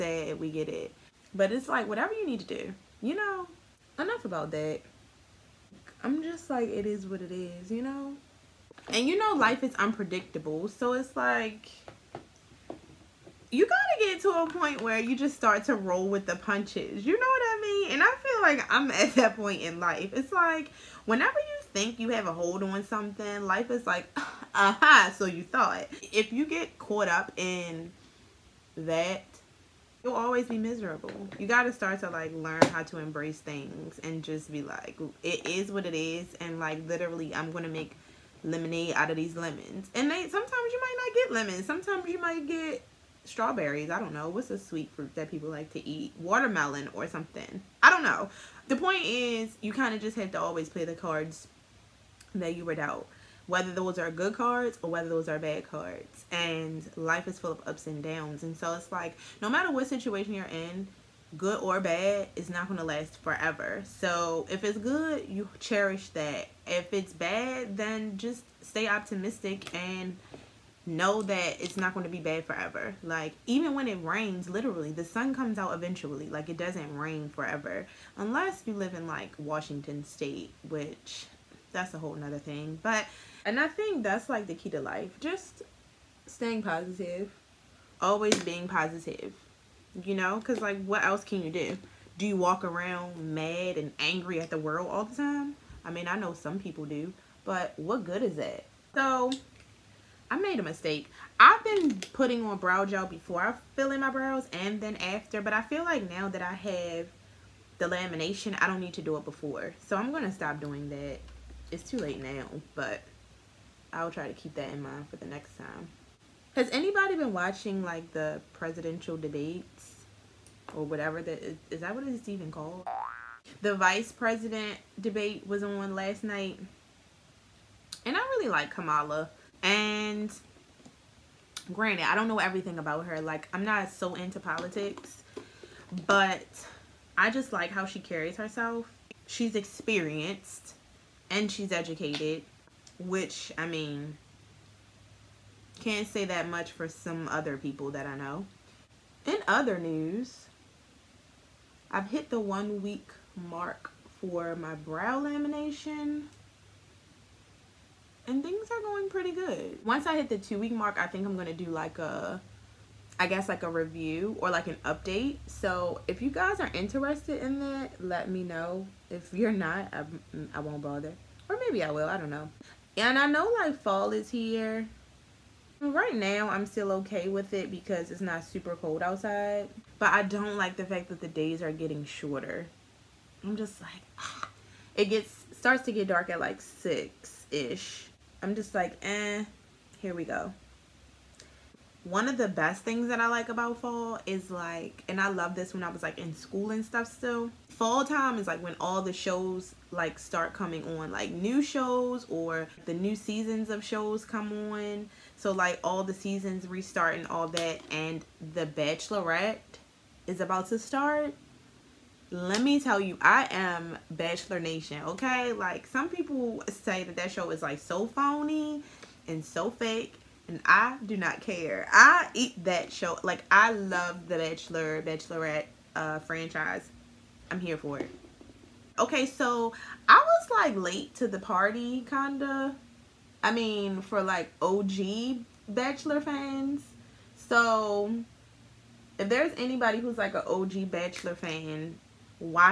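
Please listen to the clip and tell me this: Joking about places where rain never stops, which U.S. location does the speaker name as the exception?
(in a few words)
Washington state.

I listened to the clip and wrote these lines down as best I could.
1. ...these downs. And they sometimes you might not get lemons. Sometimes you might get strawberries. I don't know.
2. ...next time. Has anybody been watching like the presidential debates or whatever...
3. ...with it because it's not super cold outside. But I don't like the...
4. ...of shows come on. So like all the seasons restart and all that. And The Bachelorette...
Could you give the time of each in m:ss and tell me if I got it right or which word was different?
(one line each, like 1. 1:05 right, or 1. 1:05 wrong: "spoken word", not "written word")
1. 0:39 wrong: "lemons", not "downs"
2. 1:55 right
3. 2:57 right
4. 3:23 right.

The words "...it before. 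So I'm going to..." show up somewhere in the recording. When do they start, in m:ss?
1:49.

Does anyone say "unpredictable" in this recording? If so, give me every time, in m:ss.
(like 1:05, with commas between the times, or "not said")
0:09.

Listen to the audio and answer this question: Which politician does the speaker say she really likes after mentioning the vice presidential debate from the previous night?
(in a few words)
Kamala.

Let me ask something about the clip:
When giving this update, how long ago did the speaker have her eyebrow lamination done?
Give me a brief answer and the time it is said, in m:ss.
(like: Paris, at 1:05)
1 week, at 2:32.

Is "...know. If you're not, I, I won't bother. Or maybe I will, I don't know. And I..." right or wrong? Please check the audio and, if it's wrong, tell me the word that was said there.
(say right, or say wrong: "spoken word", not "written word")
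right.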